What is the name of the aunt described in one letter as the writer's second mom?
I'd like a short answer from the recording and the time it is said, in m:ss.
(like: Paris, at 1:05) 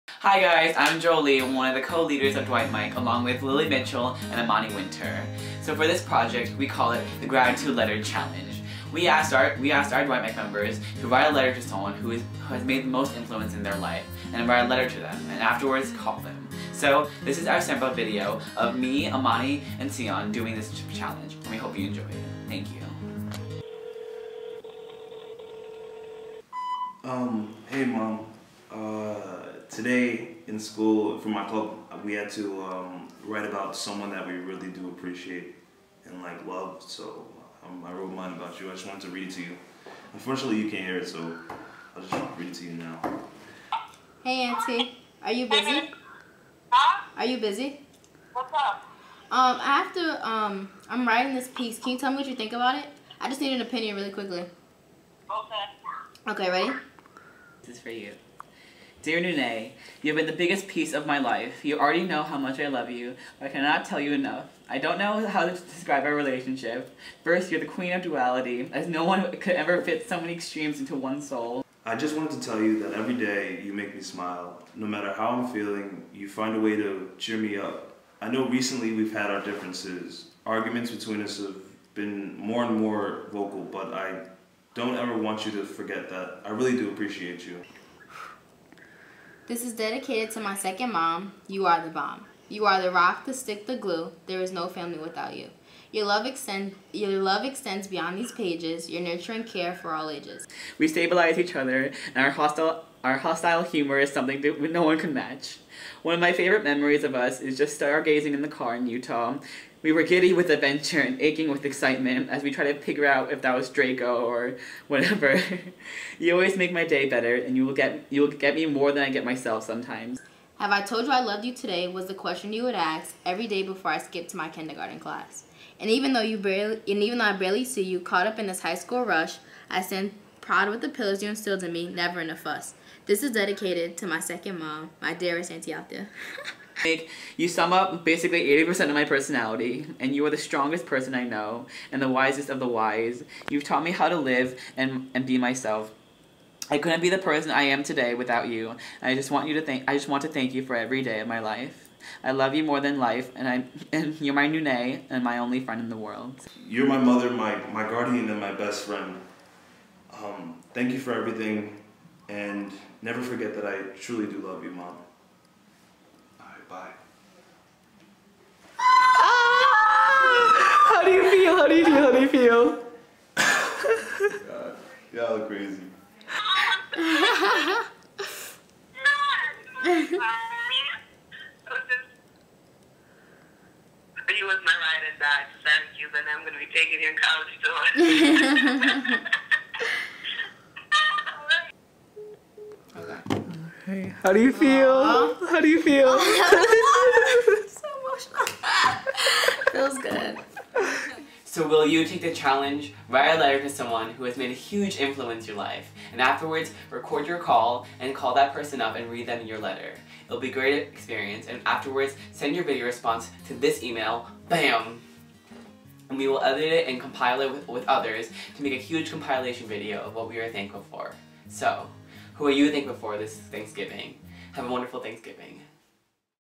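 Althea, at 2:15.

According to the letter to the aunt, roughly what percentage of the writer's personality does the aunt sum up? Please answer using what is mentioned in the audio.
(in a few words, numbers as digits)
80%.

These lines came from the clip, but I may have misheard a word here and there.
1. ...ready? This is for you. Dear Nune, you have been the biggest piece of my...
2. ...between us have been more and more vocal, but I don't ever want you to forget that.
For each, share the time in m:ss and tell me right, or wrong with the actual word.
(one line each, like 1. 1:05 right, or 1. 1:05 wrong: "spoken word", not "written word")
1. 0:56 right
2. 1:20 right.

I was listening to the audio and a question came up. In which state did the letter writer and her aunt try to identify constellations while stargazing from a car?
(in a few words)
Utah.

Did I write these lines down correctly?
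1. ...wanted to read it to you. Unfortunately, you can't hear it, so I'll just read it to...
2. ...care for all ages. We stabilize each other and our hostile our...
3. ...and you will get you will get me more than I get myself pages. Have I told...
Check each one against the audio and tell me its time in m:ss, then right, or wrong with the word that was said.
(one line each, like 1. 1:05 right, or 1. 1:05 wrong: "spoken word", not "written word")
1. 0:38 right
2. 1:39 right
3. 1:57 wrong: "sometimes", not "pages".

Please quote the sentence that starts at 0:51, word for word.
Can you tell me what you think about it?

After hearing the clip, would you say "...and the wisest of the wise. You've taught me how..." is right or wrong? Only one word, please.
right.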